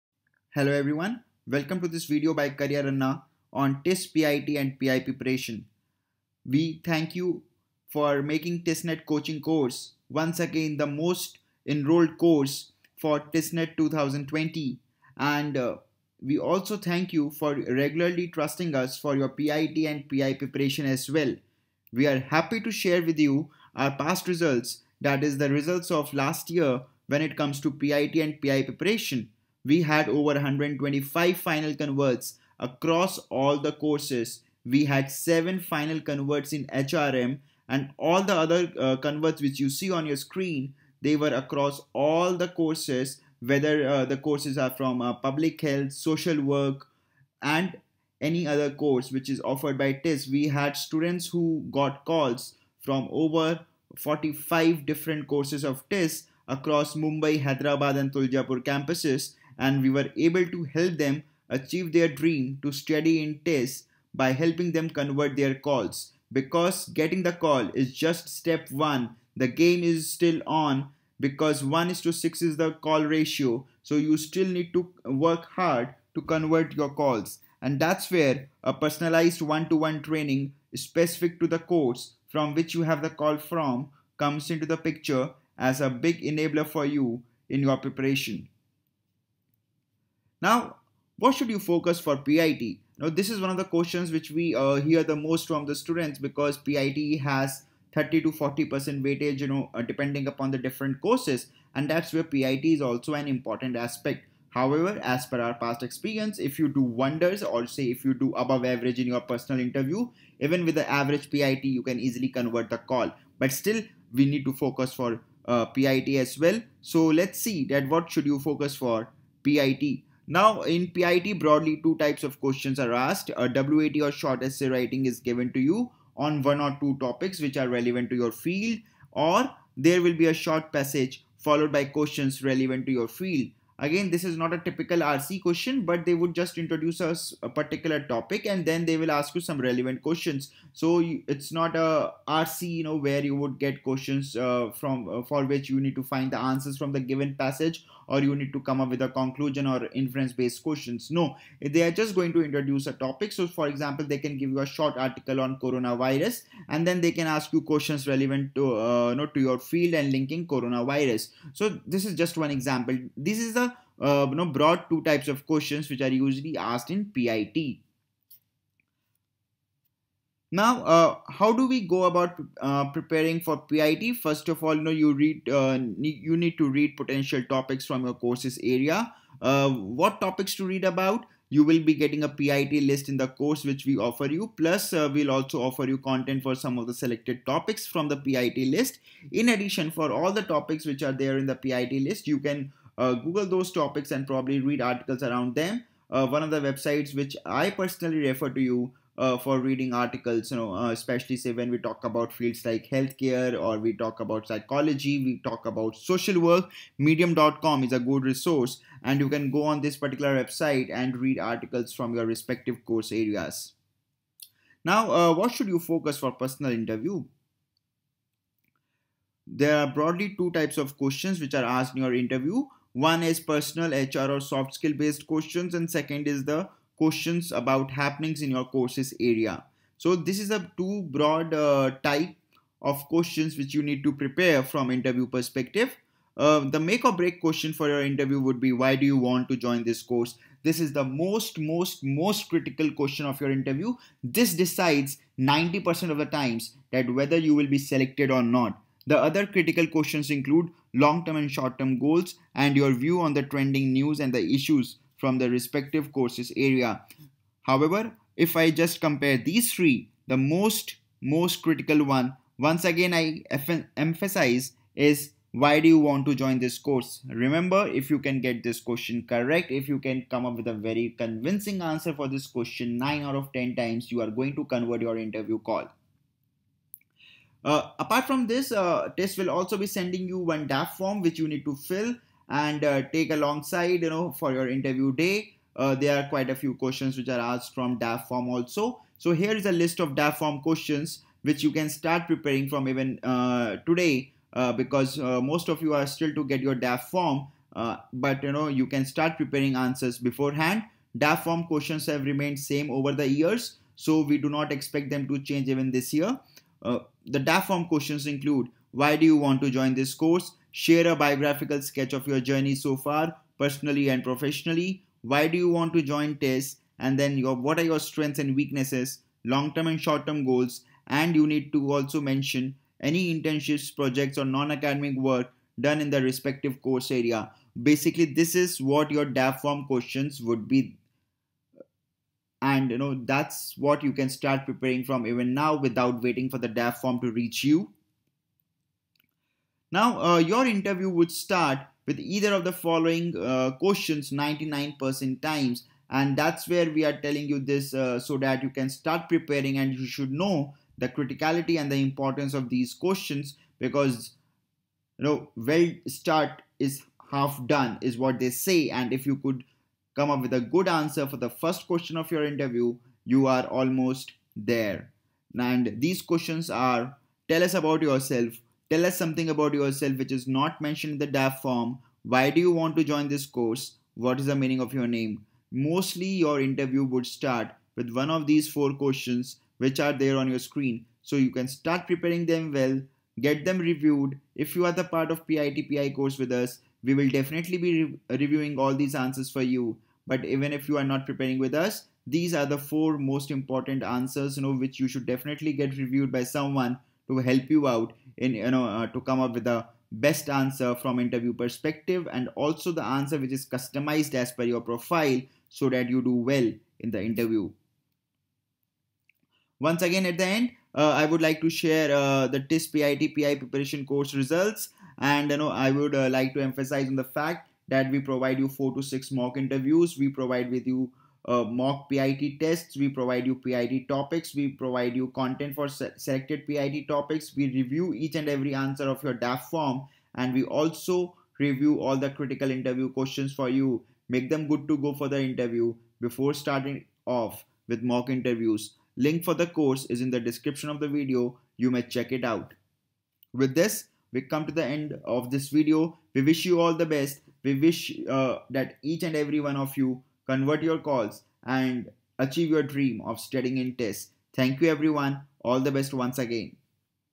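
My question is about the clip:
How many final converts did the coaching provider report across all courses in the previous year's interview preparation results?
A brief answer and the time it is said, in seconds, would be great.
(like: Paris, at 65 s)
125, at 30 s.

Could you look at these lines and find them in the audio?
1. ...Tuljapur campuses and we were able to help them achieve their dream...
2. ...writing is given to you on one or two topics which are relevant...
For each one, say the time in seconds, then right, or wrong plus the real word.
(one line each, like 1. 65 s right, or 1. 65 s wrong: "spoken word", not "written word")
1. 58 s right
2. 124 s right.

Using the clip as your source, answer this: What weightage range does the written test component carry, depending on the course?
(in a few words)
30 to 40%.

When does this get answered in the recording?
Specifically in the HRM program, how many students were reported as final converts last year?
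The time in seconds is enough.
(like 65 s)
35 s.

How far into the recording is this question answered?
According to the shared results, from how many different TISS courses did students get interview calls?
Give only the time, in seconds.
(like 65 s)
53 s.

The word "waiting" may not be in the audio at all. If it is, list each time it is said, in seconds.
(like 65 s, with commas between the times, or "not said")
336 s.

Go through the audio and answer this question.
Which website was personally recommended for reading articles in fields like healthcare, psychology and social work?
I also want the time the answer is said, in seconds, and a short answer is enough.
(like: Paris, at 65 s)
medium.com, at 206 s.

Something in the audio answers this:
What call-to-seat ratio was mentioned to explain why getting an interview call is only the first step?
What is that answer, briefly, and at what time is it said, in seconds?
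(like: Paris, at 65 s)
1 to 6, at 71 s.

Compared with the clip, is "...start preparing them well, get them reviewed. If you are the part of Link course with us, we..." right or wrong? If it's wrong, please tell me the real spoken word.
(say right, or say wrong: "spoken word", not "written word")
wrong: "PITPI", not "Link".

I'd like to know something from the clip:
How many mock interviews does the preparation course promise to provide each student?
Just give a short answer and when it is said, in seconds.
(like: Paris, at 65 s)
4 to 6, at 418 s.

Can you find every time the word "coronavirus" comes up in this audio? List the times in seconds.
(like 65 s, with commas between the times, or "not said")
155 s, 160 s.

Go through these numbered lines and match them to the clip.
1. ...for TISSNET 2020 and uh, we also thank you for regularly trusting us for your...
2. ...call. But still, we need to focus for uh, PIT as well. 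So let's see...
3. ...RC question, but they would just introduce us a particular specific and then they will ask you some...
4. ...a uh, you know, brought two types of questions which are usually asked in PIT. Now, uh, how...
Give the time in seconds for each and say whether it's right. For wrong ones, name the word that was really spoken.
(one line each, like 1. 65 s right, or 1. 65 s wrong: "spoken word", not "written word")
1. 12 s right
2. 112 s right
3. 134 s wrong: "topic", not "specific"
4. 163 s right.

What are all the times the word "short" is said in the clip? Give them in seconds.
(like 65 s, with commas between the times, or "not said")
124 s, 130 s, 154 s, 251 s, 320 s.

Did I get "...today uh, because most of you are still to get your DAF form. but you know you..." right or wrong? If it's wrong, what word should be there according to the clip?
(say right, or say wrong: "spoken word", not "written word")
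right.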